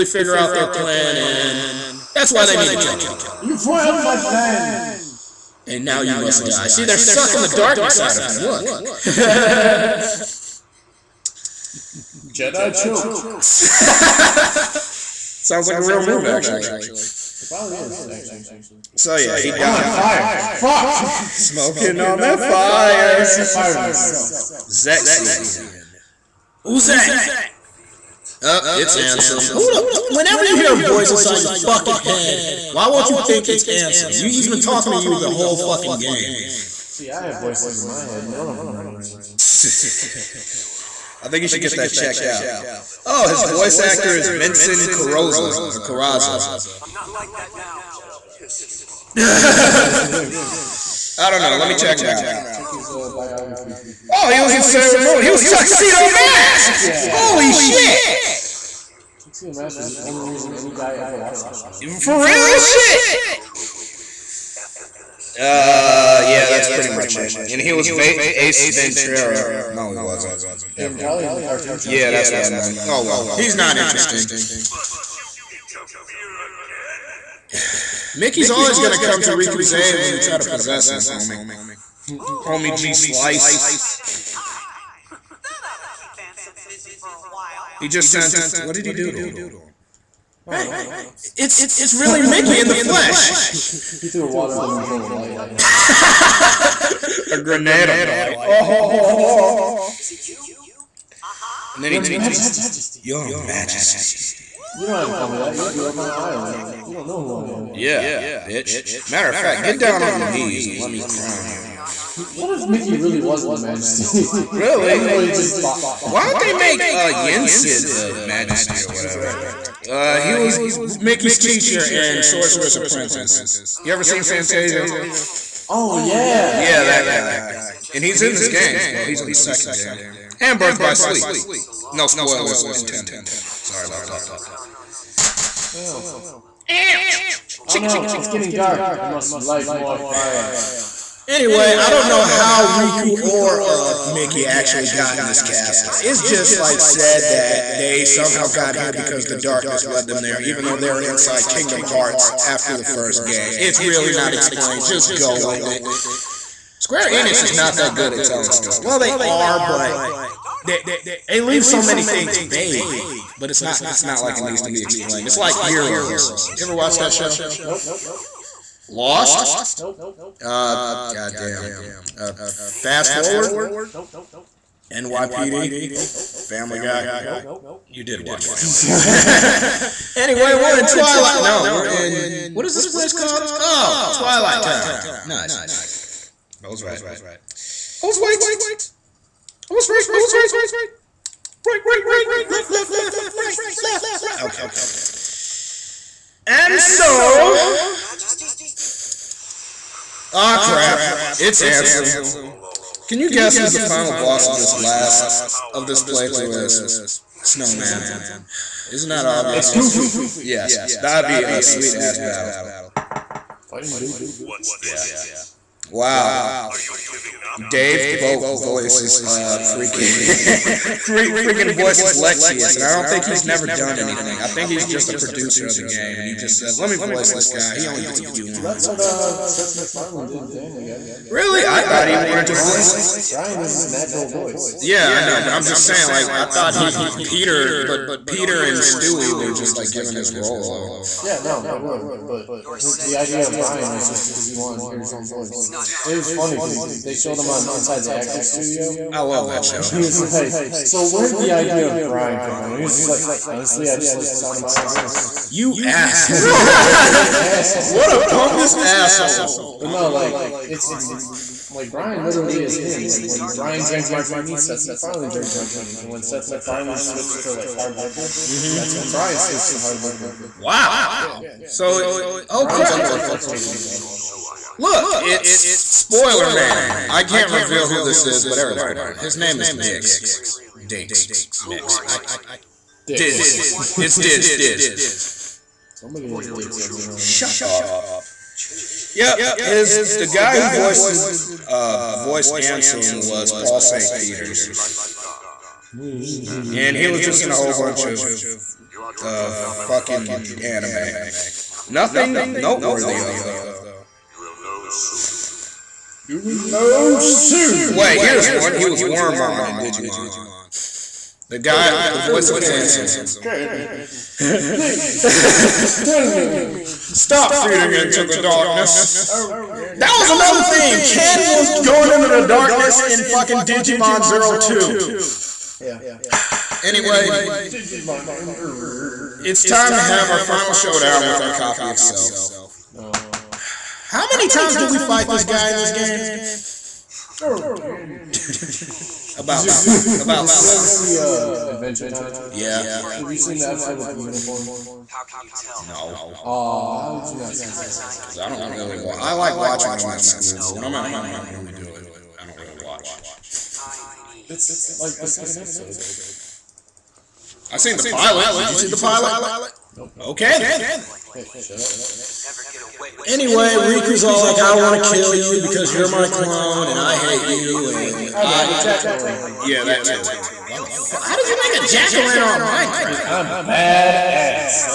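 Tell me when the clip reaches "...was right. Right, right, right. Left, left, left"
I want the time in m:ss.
3:10.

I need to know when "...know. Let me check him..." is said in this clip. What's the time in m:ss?
0:51.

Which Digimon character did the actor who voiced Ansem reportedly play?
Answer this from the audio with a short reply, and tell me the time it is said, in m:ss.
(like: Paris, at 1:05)
Wormmon, at 5:09.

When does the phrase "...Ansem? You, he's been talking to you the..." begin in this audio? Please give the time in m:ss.
0:33.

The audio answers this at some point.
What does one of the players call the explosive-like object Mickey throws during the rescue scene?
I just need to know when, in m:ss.
1:37.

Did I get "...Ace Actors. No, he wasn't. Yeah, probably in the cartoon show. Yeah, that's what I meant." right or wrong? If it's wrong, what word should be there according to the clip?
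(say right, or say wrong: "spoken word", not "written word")
wrong: "Ventura", not "Actors".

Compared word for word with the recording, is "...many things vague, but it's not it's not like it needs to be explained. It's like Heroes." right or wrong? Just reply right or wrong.
right.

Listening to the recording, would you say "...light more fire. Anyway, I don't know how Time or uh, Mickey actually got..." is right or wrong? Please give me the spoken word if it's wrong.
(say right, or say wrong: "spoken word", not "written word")
wrong: "Riku", not "Time".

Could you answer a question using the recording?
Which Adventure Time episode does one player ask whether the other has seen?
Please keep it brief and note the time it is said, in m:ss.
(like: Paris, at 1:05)
the episode with the unicorn, at 5:43.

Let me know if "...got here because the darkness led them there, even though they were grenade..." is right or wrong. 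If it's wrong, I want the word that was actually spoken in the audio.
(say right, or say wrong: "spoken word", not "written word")
wrong: "inside", not "grenade".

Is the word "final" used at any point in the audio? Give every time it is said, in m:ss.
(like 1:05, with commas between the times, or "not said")
3:23, 5:30.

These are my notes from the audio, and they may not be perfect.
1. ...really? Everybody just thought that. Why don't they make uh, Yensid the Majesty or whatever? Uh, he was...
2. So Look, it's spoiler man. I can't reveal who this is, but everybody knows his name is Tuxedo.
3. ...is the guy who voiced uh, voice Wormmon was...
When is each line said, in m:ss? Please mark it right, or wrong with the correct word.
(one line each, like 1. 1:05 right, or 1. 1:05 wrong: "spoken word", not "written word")
1. 1:54 right
2. 4:34 wrong: "Dix", not "Tuxedo"
3. 4:49 wrong: "Ansem", not "Wormmon".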